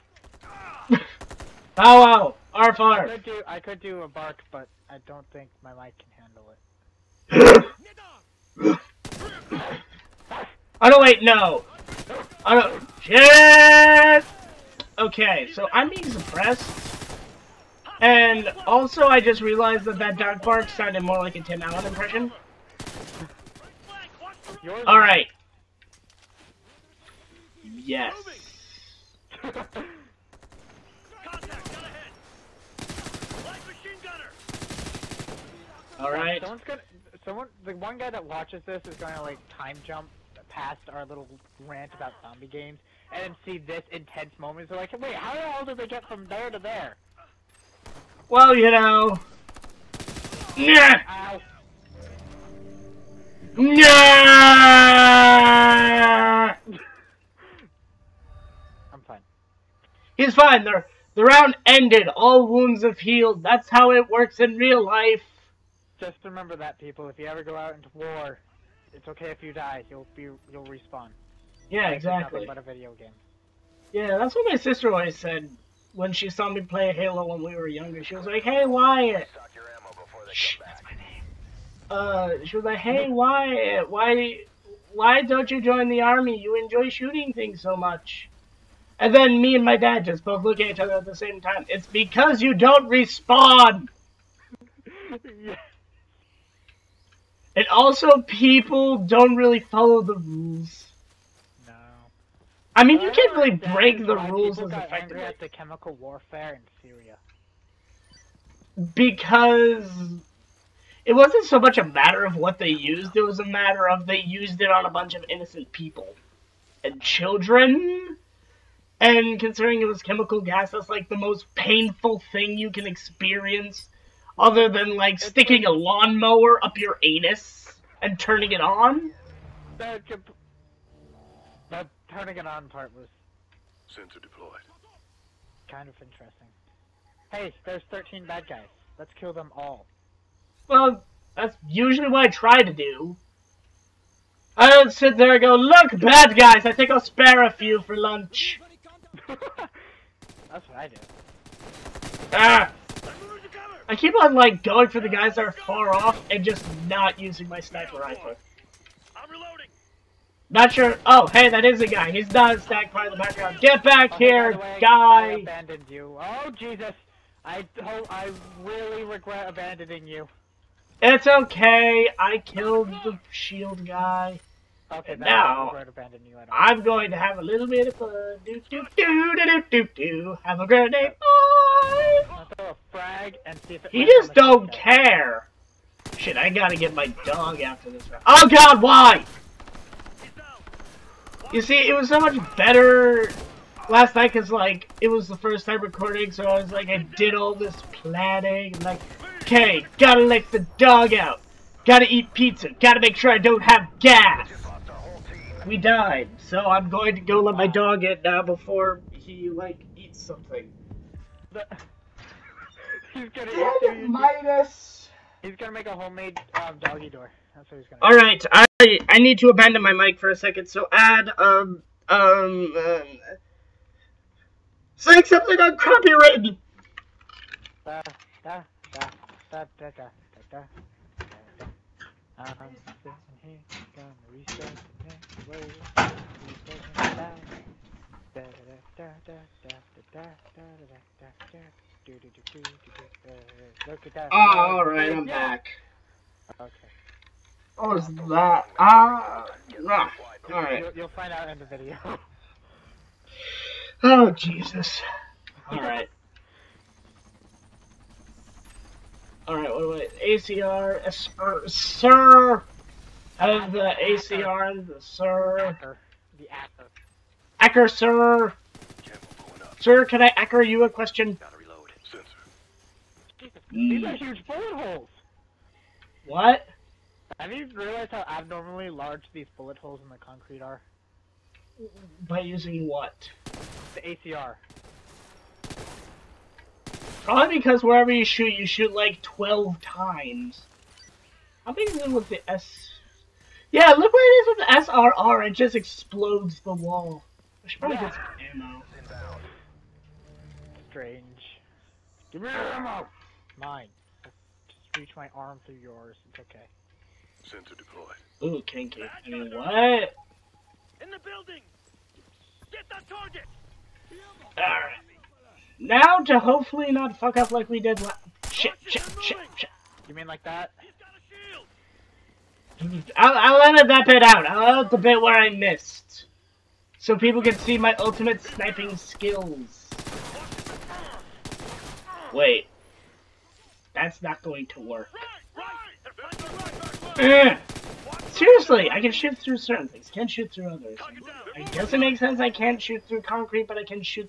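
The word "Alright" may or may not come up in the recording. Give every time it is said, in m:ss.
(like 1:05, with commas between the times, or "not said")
0:24, 0:35, 5:14.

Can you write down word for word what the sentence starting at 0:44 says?
So like, wait, how the hell did they get from there to there?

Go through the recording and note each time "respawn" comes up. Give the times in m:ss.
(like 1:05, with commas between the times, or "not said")
1:10, 1:32.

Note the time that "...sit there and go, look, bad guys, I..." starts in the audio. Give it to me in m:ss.
2:24.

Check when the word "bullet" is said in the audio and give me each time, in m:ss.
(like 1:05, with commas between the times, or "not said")
4:34, 4:39.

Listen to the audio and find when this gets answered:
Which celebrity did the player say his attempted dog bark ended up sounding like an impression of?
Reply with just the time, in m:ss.
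0:21.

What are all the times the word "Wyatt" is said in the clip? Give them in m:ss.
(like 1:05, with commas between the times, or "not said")
1:18, 1:23.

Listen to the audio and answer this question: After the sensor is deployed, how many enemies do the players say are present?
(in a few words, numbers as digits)
13.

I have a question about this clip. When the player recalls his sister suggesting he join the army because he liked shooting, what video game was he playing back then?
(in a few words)
Halo.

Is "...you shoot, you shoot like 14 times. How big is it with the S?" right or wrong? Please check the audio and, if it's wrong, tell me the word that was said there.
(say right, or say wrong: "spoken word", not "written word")
wrong: "12", not "14".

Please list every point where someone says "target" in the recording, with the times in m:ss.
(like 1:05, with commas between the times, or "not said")
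5:13.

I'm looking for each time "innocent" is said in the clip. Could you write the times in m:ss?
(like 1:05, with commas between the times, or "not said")
1:55.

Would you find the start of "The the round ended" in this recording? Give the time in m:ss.
1:00.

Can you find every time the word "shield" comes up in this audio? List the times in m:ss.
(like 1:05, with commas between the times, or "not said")
2:53.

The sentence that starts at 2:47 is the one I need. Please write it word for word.
I, oh, I really regret abandoning you.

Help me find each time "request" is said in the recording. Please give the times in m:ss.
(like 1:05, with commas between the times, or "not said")
not said.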